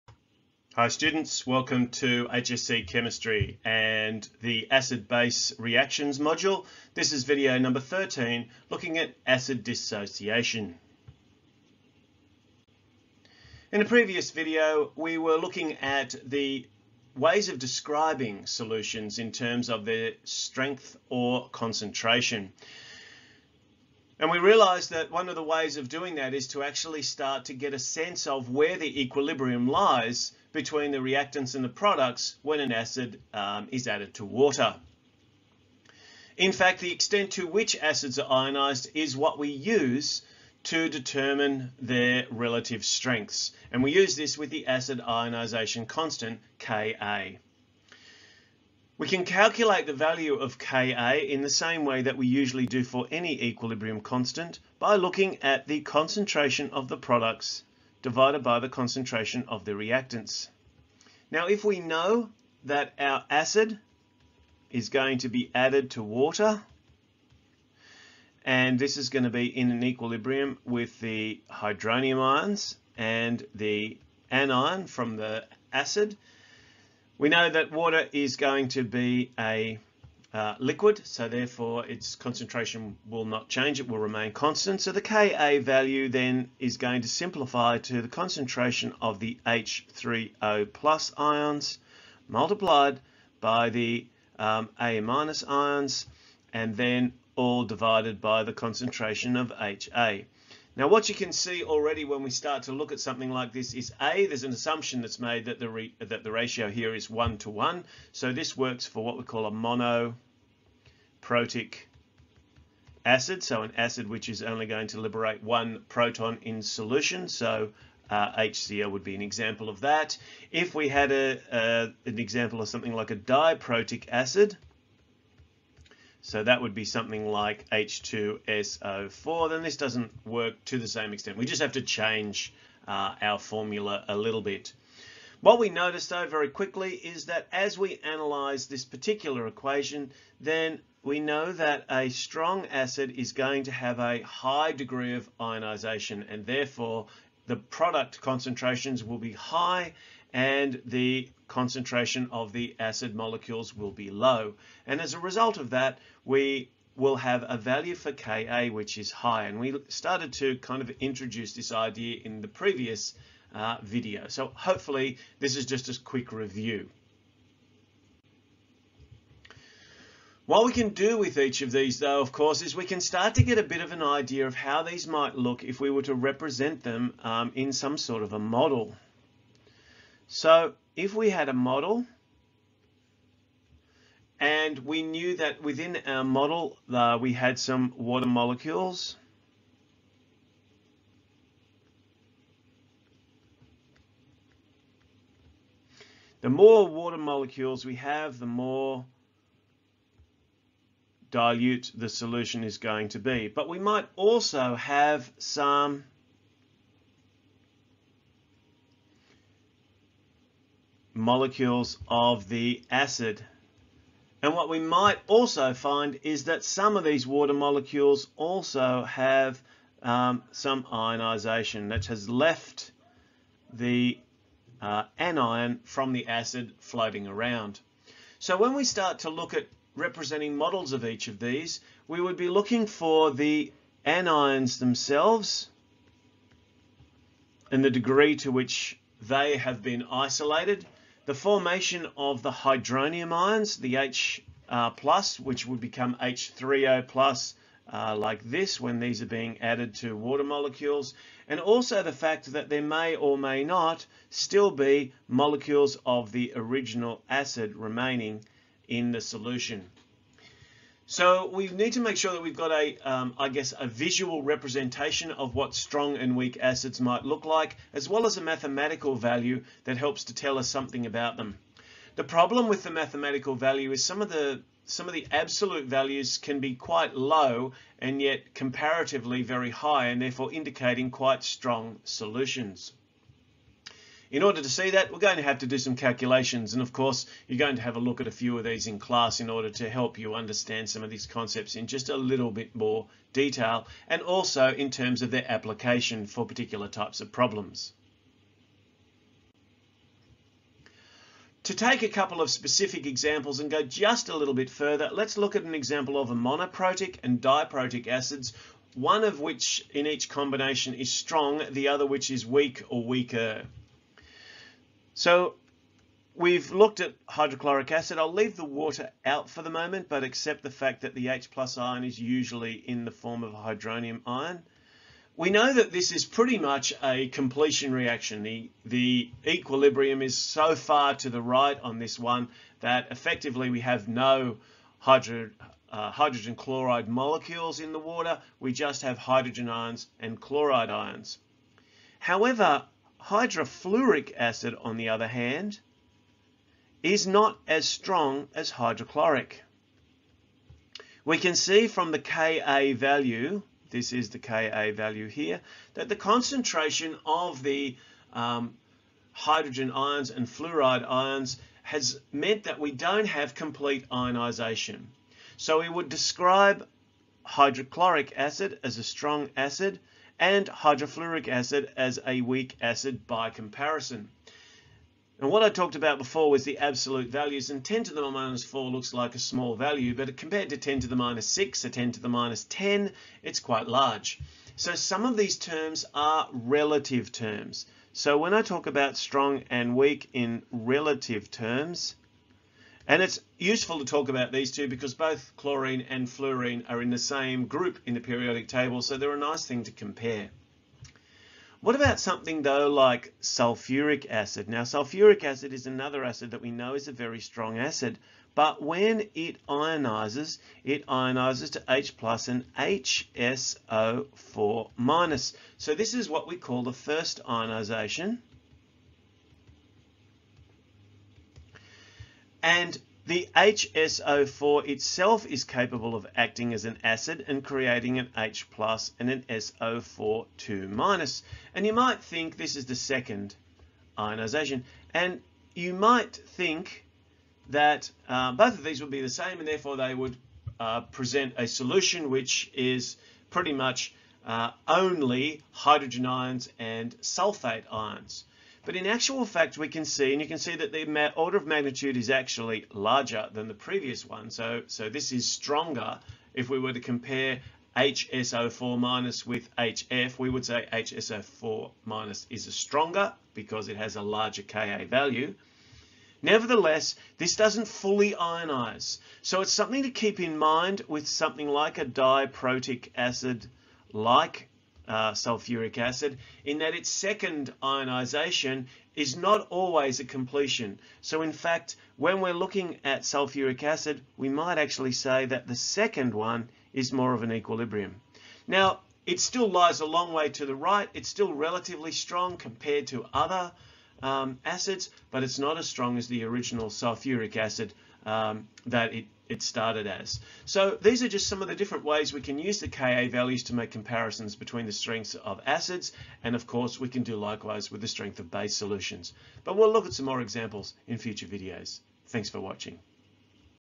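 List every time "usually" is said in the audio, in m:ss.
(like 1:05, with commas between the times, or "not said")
0:52, 5:22.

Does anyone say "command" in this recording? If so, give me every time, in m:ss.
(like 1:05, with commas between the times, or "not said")
not said.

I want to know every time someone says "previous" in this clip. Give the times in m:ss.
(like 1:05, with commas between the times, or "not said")
0:13, 2:42, 7:33.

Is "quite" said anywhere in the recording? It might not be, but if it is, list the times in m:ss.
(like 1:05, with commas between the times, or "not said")
4:36, 4:41, 6:23.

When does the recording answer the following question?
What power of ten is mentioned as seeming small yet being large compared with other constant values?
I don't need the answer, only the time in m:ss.
6:17.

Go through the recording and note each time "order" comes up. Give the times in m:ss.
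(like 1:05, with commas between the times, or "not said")
4:44, 4:49, 7:31.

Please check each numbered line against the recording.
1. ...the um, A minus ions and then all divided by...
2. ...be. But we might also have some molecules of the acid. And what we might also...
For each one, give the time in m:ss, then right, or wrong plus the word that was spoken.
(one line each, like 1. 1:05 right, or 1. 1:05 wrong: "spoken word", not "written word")
1. 1:33 right
2. 3:23 right.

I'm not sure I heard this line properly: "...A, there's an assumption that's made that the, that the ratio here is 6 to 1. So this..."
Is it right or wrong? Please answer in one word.
wrong.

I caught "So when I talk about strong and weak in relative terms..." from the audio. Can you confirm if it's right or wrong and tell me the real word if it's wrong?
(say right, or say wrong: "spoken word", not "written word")
right.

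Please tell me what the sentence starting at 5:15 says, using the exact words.
So we've looked at hydrochloric acid.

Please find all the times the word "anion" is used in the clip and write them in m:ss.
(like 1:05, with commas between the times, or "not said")
1:14, 3:45, 3:54.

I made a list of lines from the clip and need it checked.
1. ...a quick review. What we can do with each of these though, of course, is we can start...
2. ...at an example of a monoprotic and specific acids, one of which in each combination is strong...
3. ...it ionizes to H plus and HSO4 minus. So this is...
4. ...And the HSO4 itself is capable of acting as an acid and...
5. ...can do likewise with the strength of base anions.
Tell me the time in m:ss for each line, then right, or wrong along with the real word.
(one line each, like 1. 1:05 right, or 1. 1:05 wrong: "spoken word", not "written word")
1. 2:45 right
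2. 5:05 wrong: "diprotic", not "specific"
3. 6:50 right
4. 7:02 right
5. 8:27 wrong: "solutions", not "anions".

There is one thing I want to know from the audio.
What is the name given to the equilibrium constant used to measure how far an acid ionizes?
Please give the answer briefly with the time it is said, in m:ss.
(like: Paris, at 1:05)
acid ionization constant, at 0:44.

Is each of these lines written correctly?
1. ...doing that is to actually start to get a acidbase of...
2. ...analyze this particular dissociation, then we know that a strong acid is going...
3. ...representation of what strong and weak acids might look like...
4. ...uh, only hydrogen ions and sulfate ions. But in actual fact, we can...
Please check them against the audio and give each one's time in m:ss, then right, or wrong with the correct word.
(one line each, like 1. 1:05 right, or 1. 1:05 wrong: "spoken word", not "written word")
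1. 0:25 wrong: "sense", not "acidbase"
2. 2:18 wrong: "equation", not "dissociation"
3. 4:24 right
4. 7:24 right.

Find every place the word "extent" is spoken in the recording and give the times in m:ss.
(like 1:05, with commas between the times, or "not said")
0:36, 2:11.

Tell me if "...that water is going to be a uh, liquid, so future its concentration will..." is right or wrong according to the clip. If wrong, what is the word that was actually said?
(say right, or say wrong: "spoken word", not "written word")
wrong: "therefore", not "future".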